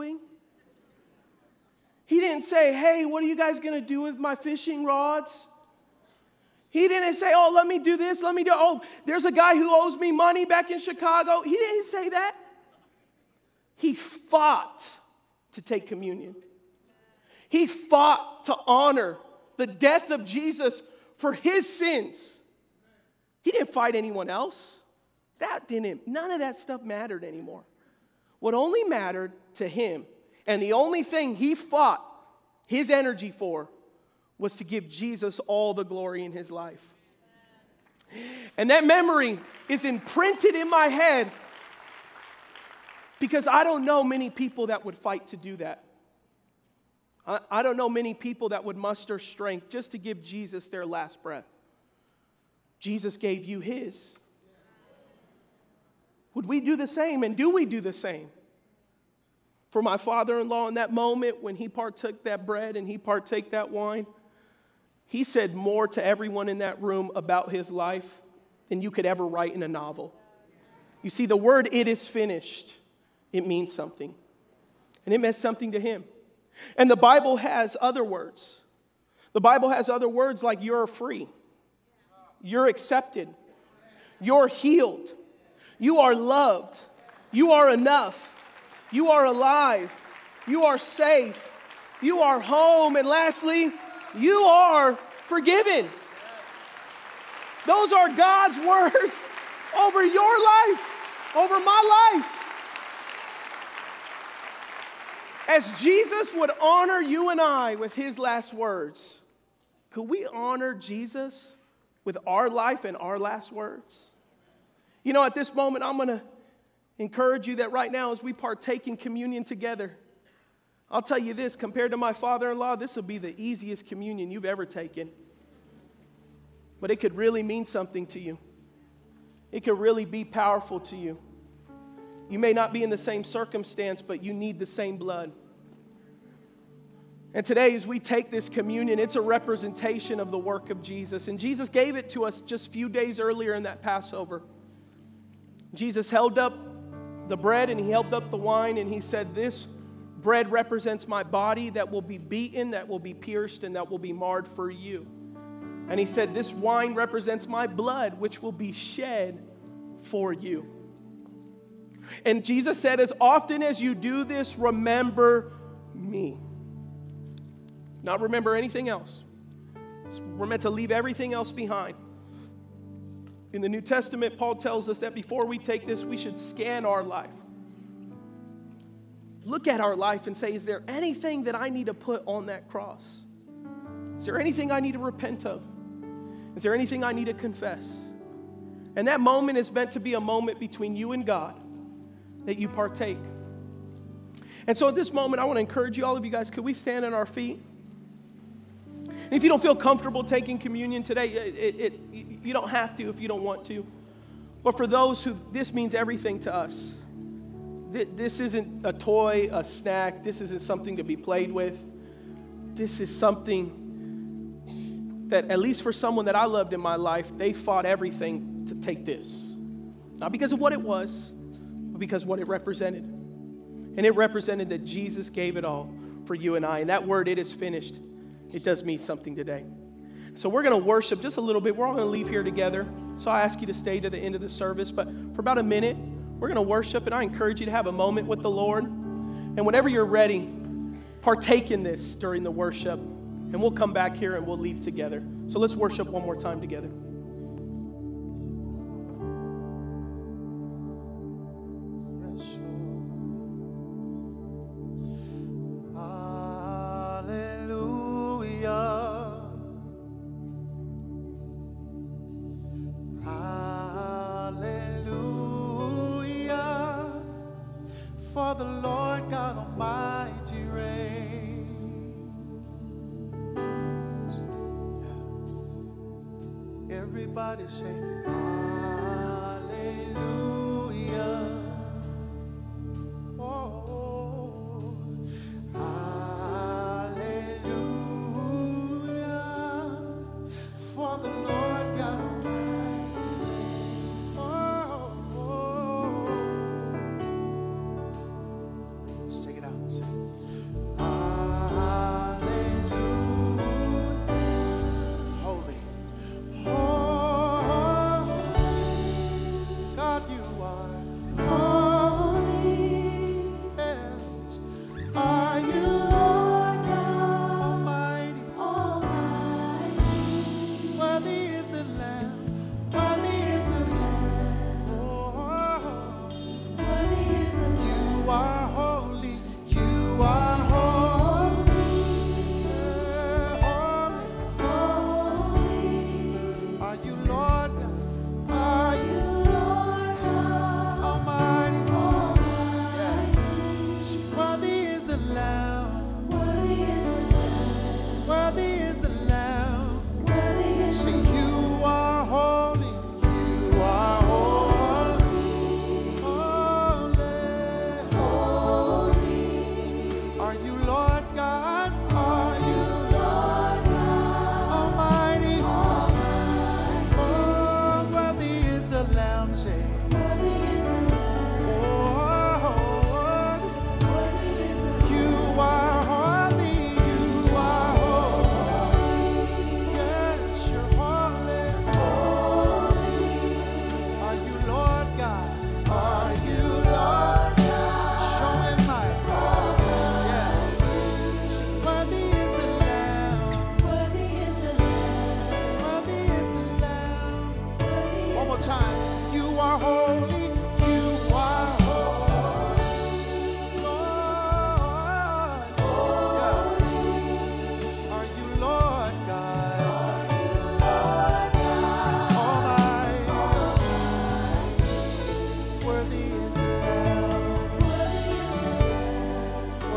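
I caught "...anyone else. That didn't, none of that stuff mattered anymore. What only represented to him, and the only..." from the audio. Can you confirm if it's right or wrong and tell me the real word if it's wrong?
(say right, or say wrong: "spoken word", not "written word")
wrong: "mattered", not "represented".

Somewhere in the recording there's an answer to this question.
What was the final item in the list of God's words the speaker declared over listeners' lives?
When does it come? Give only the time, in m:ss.
1:34.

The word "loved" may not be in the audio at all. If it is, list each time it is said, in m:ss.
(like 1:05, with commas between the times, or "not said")
1:26, 3:36.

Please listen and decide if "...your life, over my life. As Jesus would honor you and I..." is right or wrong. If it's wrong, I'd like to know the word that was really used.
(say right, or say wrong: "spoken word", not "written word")
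right.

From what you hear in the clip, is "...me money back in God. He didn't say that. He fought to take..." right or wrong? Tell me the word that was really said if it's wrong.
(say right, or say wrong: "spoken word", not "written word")
wrong: "Chicago", not "God".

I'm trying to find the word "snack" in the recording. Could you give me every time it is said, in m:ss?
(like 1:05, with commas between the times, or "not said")
3:29.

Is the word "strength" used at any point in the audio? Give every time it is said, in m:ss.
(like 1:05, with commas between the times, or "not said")
0:49.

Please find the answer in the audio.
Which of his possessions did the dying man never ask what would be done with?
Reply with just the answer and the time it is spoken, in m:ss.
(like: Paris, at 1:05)
fishing rods, at 0:04.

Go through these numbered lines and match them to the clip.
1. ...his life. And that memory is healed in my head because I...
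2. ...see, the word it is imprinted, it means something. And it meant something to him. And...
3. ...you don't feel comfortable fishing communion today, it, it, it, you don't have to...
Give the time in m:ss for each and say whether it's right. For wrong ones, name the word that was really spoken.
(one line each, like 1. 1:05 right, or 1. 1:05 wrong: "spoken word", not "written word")
1. 0:36 wrong: "imprinted", not "healed"
2. 1:11 wrong: "finished", not "imprinted"
3. 3:19 wrong: "taking", not "fishing".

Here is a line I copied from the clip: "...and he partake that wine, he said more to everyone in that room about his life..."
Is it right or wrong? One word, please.
right.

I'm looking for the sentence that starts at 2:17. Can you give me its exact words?
And today, as we take this communion, it's a representation of the work of Jesus.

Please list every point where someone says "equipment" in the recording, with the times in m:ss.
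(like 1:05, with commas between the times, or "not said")
not said.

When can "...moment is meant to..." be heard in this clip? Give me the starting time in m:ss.
3:09.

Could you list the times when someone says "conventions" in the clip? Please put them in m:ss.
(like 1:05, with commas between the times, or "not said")
not said.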